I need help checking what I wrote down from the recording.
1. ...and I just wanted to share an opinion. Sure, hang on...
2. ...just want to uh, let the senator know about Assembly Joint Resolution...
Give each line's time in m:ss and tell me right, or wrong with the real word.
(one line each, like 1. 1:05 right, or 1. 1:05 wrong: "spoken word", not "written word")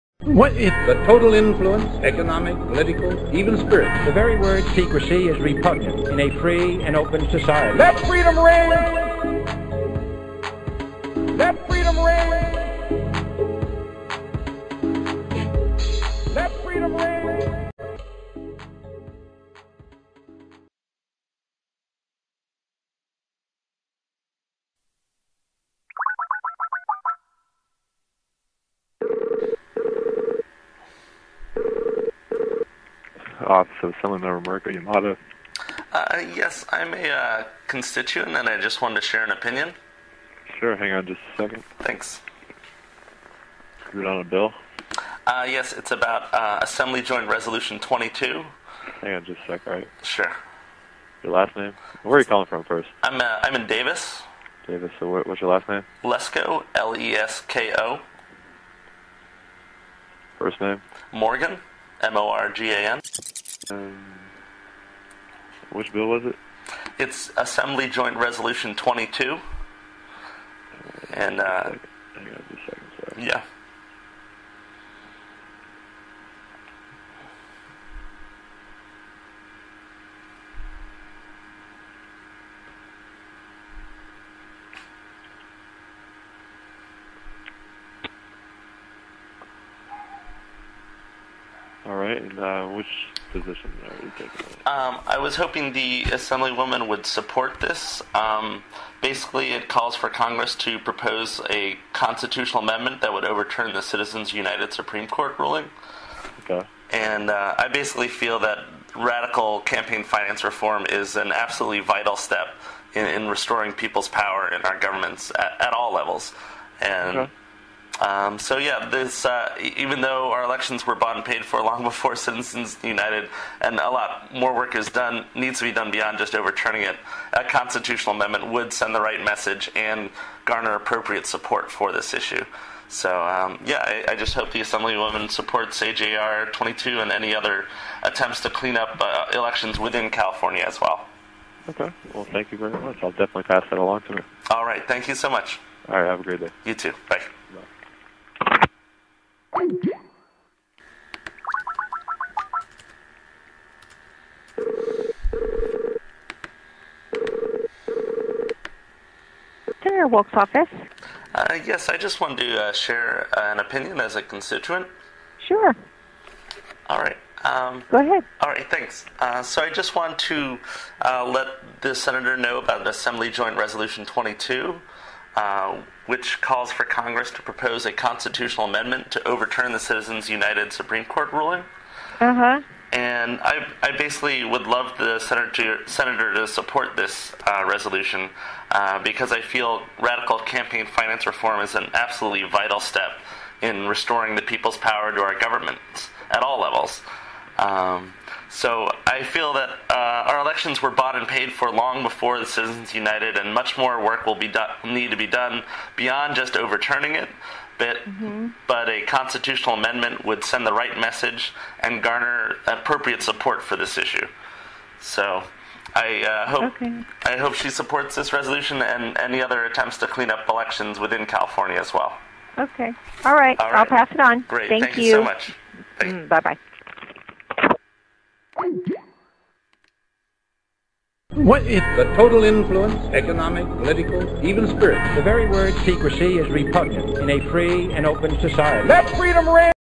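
1. 0:38 right
2. 2:49 right.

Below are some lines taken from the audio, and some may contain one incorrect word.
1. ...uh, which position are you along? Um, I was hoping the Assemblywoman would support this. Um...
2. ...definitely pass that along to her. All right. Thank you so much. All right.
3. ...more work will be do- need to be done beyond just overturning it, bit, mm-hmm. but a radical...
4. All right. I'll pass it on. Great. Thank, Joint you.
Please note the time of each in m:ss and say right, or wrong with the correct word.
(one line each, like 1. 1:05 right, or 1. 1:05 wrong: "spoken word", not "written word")
1. 1:32 wrong: "taking", not "along"
2. 2:23 right
3. 3:23 wrong: "constitutional", not "radical"
4. 3:43 wrong: "Thank", not "Joint".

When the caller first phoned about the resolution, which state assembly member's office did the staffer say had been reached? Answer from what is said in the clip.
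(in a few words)
Mariko Yamada.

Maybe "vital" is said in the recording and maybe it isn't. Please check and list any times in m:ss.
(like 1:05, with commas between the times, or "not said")
1:51, 3:12.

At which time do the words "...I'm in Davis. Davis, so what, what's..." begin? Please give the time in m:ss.
0:53.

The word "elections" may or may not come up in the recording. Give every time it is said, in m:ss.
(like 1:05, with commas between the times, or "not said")
2:00, 2:19, 3:20, 3:40.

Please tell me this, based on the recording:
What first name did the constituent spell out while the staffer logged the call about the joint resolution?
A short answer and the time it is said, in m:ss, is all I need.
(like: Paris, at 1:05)
Morgan, at 1:01.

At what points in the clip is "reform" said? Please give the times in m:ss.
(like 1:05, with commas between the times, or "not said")
1:50, 3:11.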